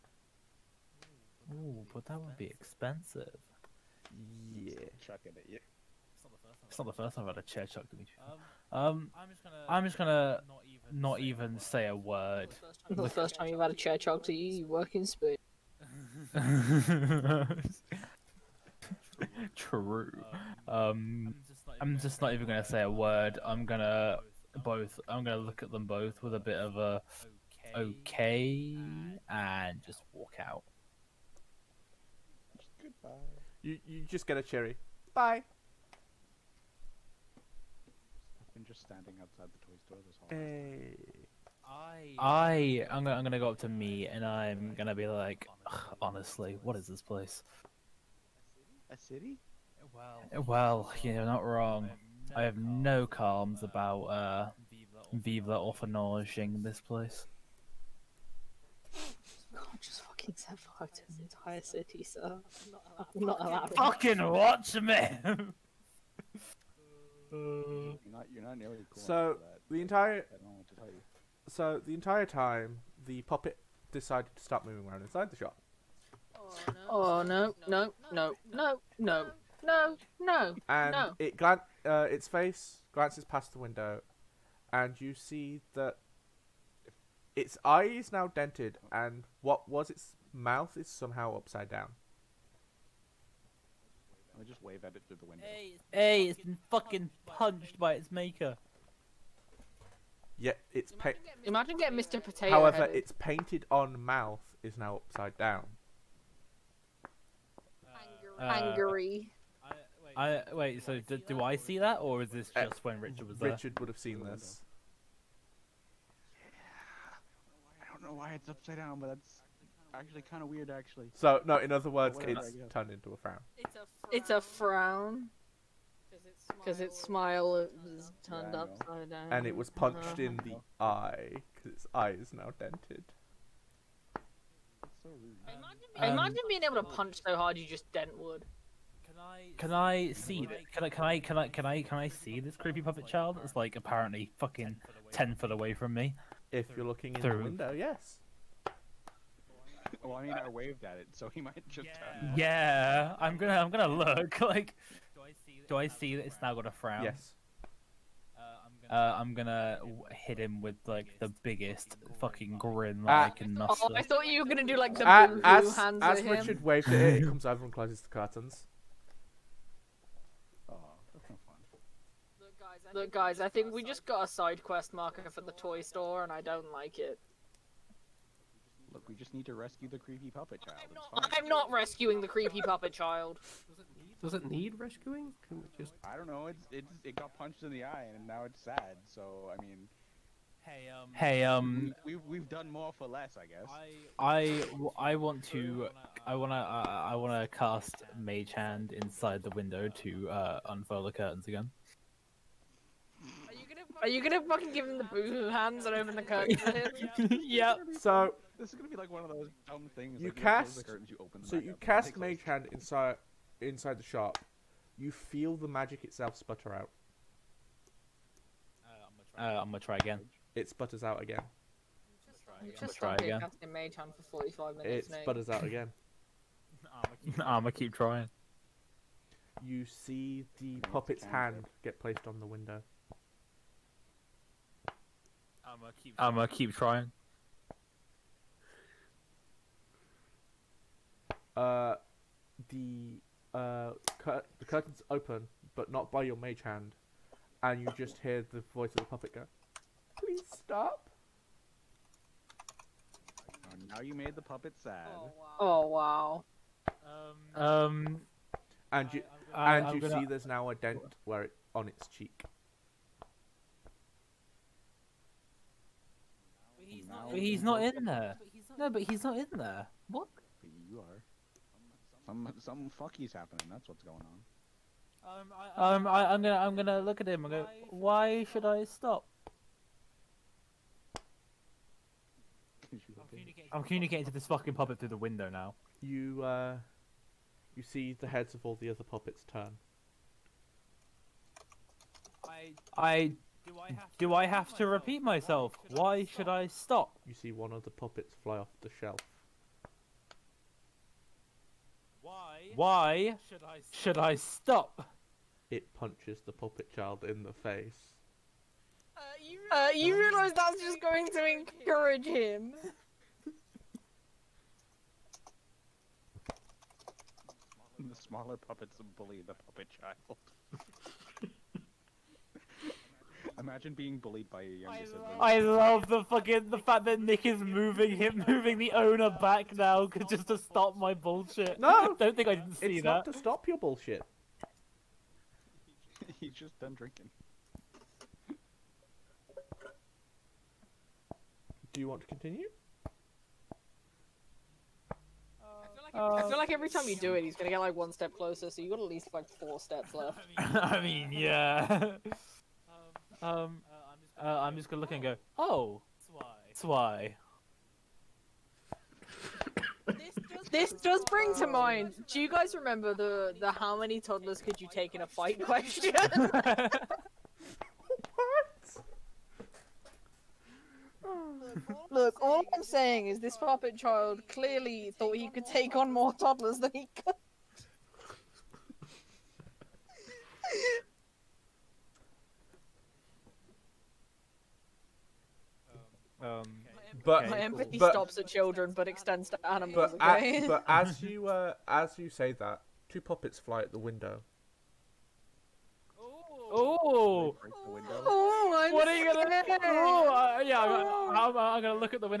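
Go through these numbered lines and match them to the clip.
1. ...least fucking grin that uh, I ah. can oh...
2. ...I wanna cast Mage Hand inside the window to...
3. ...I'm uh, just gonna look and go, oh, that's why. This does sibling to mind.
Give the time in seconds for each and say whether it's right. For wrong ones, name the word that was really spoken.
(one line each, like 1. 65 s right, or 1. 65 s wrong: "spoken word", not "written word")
1. 161 s wrong: "biggest", not "least"
2. 197 s right
3. 354 s wrong: "bring", not "sibling".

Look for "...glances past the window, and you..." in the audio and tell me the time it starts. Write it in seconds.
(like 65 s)
82 s.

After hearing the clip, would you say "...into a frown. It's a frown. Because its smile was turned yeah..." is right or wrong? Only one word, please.
right.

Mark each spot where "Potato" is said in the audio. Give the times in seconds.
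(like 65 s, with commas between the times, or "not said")
102 s.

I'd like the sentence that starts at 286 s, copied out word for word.
You, uh, you see the heads of all the other puppets turn.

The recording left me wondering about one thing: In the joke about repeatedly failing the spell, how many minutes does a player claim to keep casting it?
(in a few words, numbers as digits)
45.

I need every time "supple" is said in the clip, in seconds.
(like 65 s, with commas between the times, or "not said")
not said.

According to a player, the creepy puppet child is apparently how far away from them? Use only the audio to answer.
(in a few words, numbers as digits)
ten foot.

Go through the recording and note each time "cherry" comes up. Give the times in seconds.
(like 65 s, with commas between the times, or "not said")
34 s.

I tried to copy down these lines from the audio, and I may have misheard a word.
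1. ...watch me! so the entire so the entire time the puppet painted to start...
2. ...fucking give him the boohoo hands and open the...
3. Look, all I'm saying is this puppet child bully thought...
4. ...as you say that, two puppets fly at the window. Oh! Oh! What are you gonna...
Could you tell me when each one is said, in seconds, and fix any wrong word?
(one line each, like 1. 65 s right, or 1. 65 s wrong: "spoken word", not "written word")
1. 64 s wrong: "decided", not "painted"
2. 204 s right
3. 372 s wrong: "clearly", not "bully"
4. 391 s right.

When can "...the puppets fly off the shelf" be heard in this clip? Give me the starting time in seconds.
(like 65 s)
297 s.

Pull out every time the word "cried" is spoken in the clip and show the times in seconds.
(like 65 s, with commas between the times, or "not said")
not said.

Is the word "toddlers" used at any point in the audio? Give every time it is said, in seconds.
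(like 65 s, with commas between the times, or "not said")
364 s, 376 s.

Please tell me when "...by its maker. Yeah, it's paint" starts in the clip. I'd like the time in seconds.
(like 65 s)
97 s.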